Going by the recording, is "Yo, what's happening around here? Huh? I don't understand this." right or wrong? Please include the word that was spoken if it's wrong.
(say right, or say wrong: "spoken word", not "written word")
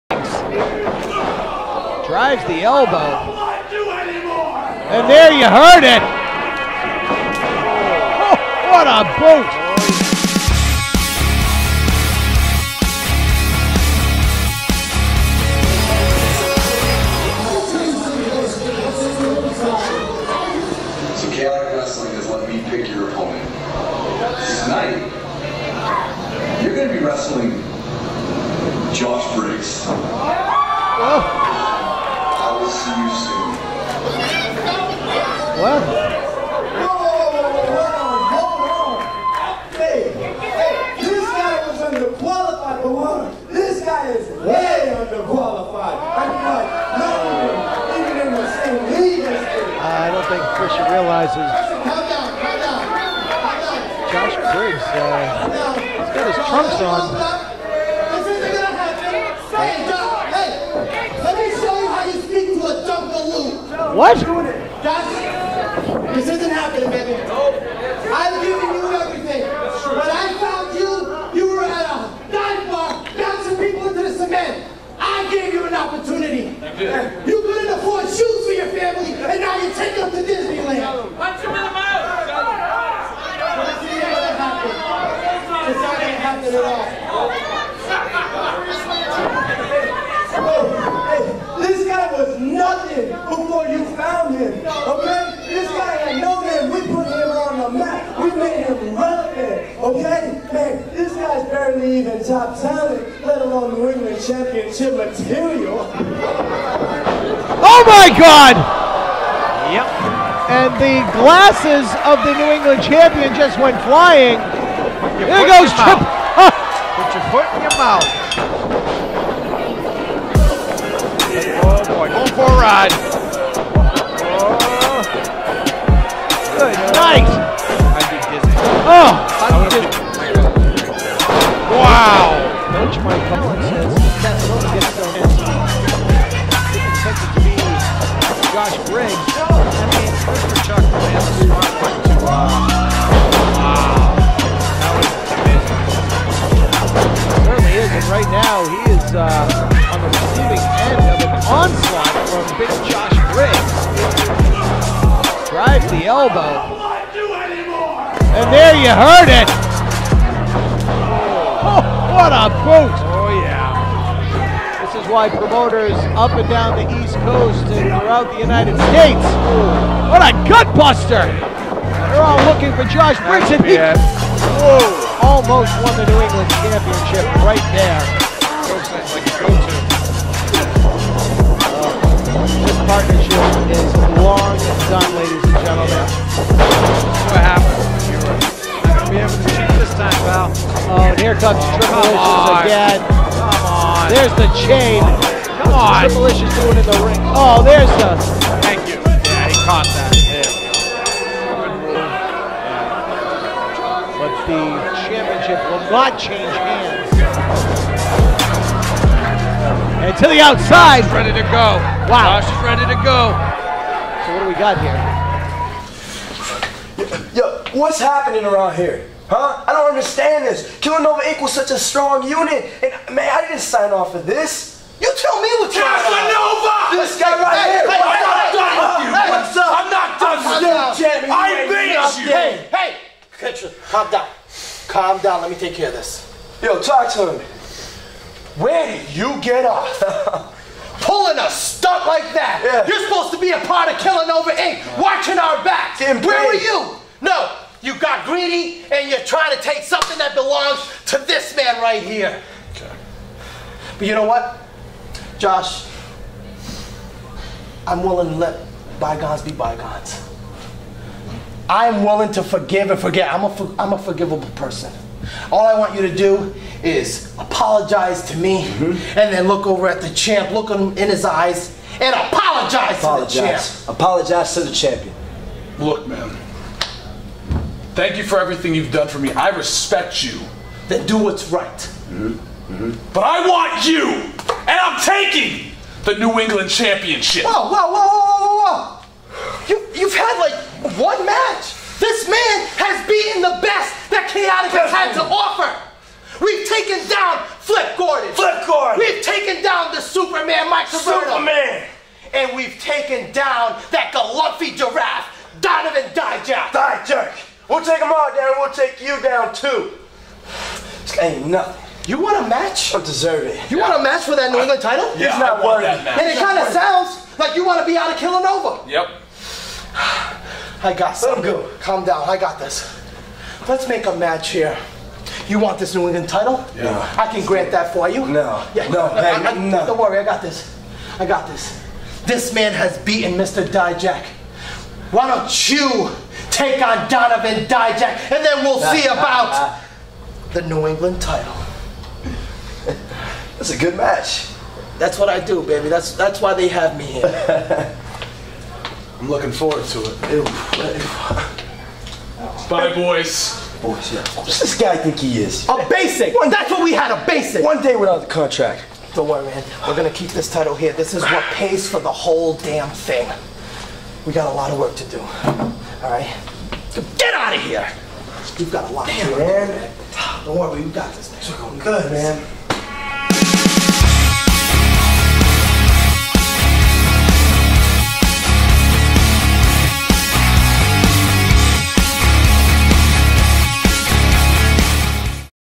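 right.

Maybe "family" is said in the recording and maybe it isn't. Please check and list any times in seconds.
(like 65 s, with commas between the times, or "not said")
78 s.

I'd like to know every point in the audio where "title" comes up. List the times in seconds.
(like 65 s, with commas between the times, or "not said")
314 s, 326 s, 341 s, 360 s.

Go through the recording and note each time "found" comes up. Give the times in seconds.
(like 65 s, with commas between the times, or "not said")
70 s, 93 s.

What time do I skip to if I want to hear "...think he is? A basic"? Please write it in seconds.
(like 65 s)
354 s.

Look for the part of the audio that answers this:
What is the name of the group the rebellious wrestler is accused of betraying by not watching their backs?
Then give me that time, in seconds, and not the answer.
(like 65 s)
243 s.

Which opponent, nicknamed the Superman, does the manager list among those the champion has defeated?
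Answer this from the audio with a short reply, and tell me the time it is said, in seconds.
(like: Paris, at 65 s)
Mike Caverna, at 300 s.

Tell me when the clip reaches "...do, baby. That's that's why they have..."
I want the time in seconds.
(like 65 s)
345 s.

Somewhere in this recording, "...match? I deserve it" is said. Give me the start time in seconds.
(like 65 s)
312 s.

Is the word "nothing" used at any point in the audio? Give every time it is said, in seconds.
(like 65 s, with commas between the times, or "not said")
92 s, 311 s.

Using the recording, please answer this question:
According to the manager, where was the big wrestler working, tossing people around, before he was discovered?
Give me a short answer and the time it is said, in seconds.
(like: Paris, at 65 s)
A dive bar, at 72 s.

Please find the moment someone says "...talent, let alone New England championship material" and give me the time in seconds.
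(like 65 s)
102 s.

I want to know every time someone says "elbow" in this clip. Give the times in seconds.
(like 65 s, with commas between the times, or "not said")
2 s, 156 s.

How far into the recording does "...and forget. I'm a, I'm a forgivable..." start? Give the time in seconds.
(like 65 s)
262 s.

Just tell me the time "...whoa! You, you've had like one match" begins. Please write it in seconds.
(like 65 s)
288 s.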